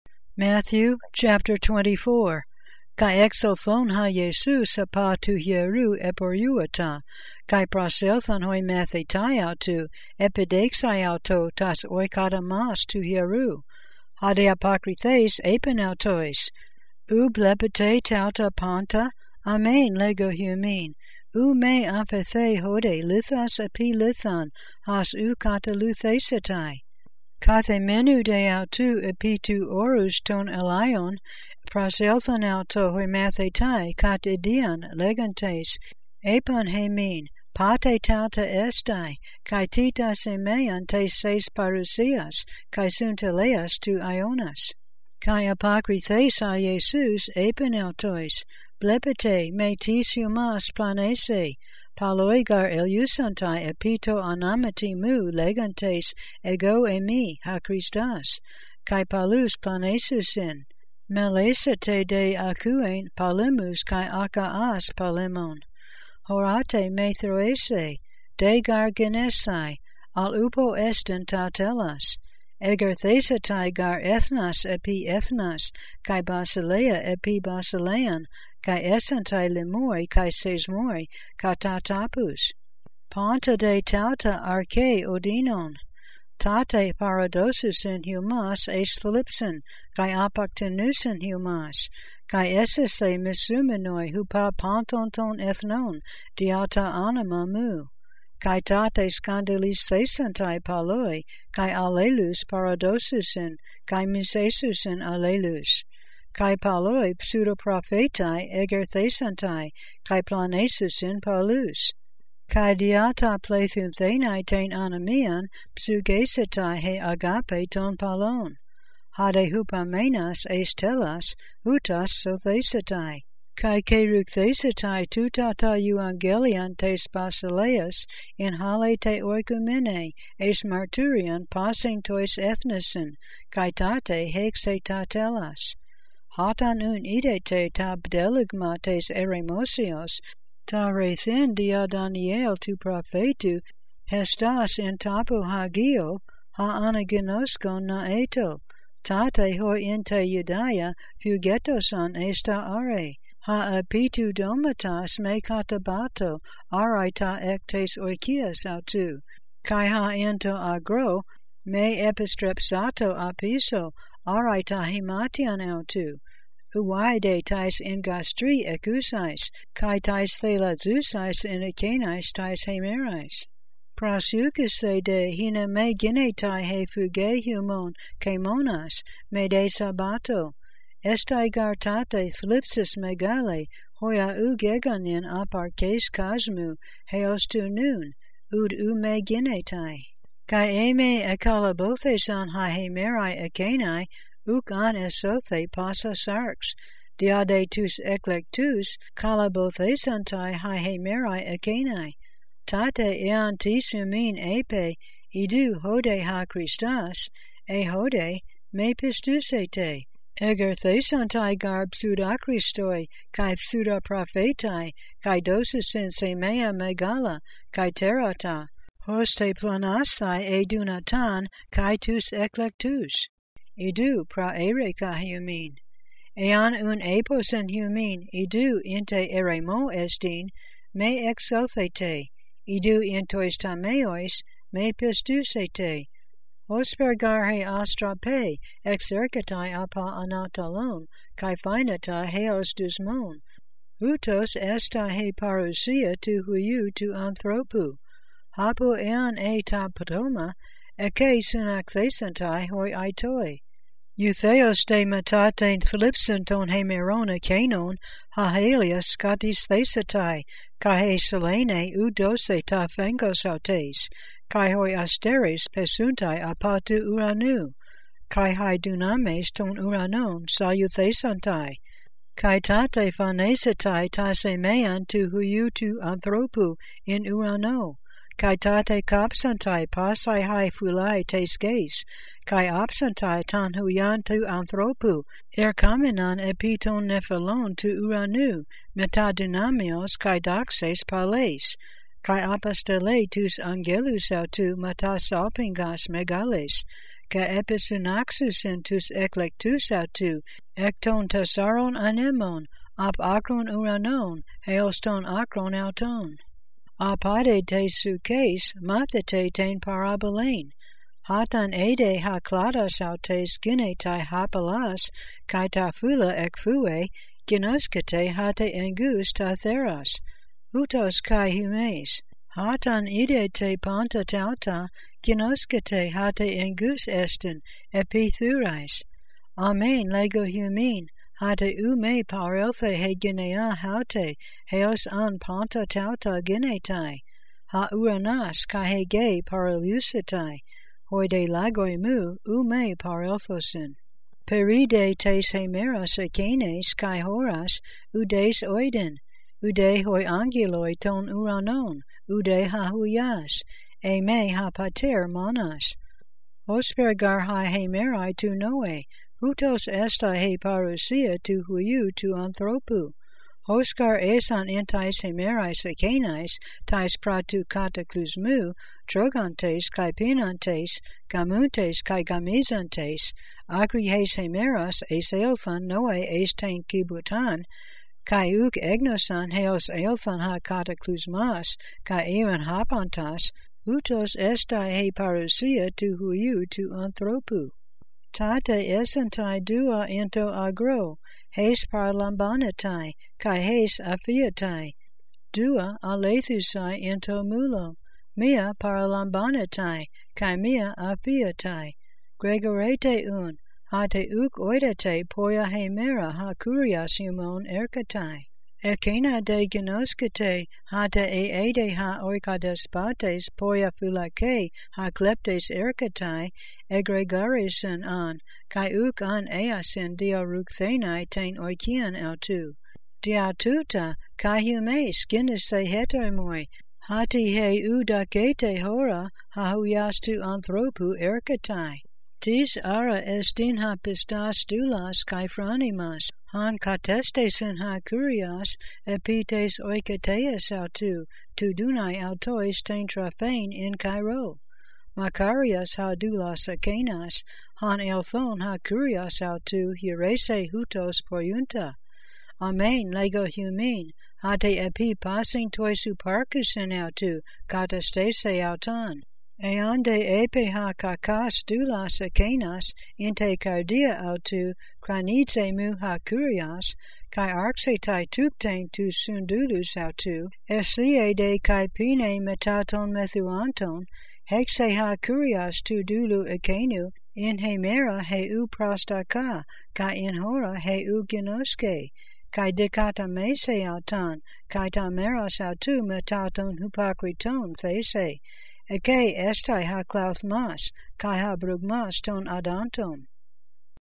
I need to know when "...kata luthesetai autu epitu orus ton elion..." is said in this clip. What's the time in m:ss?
0:25.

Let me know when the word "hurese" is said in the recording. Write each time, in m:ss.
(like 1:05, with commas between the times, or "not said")
7:30.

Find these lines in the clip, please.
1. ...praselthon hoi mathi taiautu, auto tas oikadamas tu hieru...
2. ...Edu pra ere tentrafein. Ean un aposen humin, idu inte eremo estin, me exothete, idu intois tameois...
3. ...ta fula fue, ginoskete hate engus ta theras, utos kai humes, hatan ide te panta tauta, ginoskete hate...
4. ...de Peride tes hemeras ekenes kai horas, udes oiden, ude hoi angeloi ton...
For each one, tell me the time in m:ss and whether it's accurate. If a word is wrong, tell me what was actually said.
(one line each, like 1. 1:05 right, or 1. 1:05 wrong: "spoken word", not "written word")
1. 0:07 right
2. 3:43 wrong: "humin", not "tentrafein"
3. 5:15 right
4. 5:42 right.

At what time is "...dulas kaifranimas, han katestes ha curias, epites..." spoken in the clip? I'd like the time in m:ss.
7:14.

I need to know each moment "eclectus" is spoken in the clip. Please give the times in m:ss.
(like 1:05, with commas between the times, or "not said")
3:41, 4:59.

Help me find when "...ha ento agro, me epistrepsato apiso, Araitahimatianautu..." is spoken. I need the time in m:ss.
2:39.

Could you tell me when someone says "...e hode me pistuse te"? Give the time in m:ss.
3:27.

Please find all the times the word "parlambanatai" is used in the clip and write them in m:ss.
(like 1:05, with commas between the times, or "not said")
6:31, 6:38.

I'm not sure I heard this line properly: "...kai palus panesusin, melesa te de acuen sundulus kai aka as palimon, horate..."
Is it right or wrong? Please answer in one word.
wrong.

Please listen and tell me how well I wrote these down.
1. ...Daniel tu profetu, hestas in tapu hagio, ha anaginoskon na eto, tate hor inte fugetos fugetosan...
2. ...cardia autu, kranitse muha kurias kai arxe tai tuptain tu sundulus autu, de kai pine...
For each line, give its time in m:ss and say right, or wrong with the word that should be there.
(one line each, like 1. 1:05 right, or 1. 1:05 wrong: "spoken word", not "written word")
1. 2:21 right
2. 7:43 right.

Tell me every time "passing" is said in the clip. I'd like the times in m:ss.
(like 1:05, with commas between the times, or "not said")
2:11, 7:35.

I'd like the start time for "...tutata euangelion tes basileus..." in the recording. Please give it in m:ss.
2:05.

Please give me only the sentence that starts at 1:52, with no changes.
Kai diata plethum thenai anamian, psugesetai he agape ton palon.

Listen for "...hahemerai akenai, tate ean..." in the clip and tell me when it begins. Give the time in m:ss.
3:20.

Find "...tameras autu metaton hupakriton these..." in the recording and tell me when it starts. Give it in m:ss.
8:04.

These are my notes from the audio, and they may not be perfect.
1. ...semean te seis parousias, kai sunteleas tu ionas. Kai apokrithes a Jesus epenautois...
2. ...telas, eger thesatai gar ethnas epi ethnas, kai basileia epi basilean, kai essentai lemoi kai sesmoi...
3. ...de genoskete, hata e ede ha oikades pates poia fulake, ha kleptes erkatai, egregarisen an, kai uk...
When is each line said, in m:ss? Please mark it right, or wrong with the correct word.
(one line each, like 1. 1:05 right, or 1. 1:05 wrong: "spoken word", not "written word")
1. 0:40 right
2. 1:11 right
3. 6:49 right.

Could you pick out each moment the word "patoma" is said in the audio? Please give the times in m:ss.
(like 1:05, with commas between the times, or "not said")
4:09.